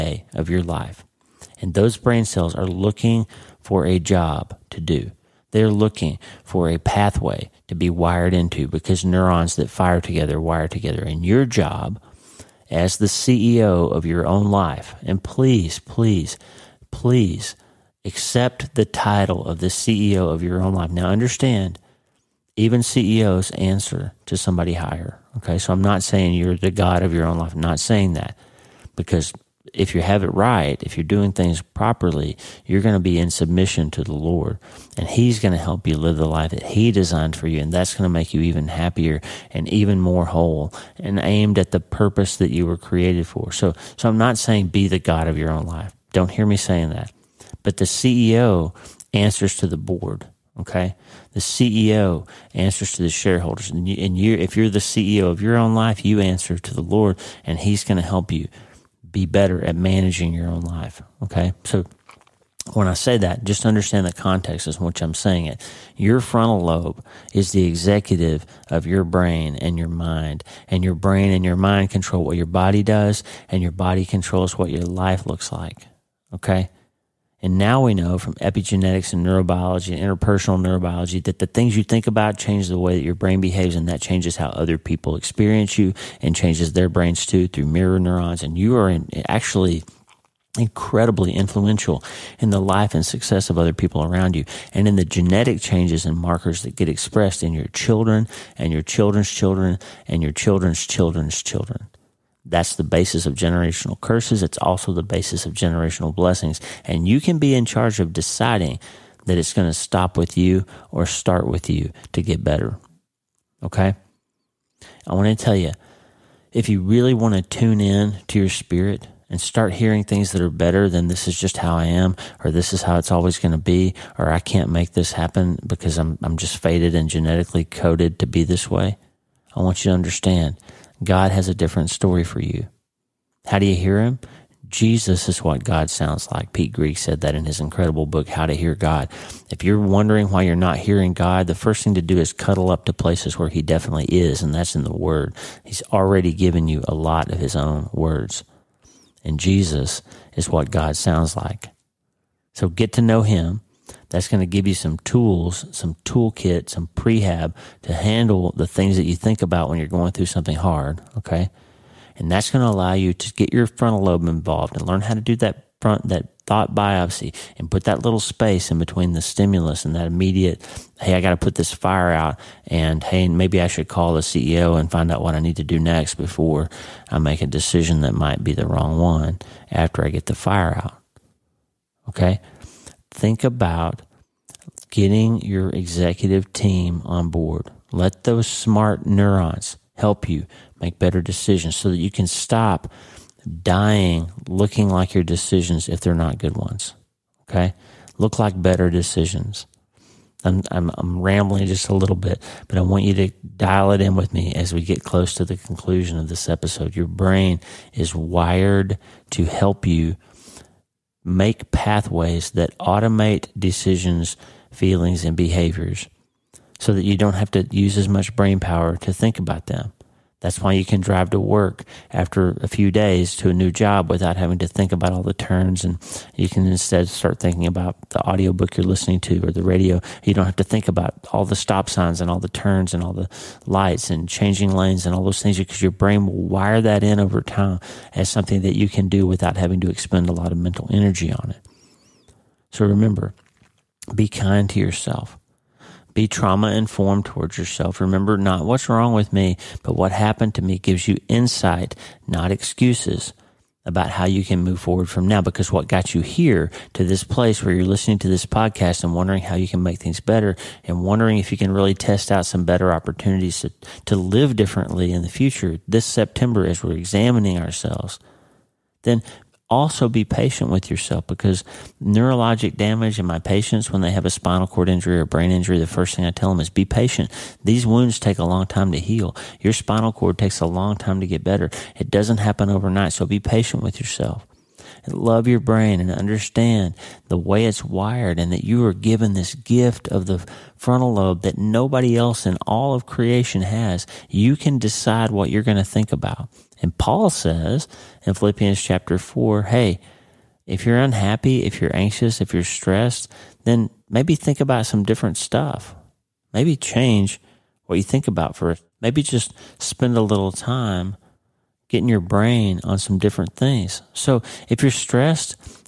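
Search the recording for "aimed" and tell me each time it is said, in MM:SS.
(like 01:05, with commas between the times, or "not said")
00:41.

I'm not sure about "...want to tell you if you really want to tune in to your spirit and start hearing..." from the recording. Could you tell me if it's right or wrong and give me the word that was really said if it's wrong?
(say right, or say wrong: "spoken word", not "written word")
right.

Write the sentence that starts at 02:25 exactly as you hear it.
He's already given you a lot of His own words.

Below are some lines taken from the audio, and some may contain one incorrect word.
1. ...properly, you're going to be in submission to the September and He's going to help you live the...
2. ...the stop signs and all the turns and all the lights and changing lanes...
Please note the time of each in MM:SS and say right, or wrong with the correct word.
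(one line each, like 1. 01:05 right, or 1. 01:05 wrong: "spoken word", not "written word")
1. 00:31 wrong: "Lord", not "September"
2. 03:51 right.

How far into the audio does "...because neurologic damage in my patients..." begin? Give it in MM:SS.
04:31.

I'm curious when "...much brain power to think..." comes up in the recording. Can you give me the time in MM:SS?
03:38.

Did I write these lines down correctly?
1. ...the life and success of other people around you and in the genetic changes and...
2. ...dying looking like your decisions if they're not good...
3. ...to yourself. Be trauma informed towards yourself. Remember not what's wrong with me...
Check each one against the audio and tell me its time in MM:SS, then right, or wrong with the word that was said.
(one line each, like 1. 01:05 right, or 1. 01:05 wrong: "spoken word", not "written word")
1. 01:32 right
2. 03:13 right
3. 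04:04 right.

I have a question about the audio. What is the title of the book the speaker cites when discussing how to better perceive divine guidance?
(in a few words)
How to Hear God.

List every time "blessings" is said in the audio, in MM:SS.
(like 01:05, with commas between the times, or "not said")
01:46.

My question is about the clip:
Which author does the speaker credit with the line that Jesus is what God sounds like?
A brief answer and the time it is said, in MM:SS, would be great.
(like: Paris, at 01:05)
Pete Greig, at 02:16.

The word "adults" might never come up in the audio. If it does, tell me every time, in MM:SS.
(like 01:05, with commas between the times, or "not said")
not said.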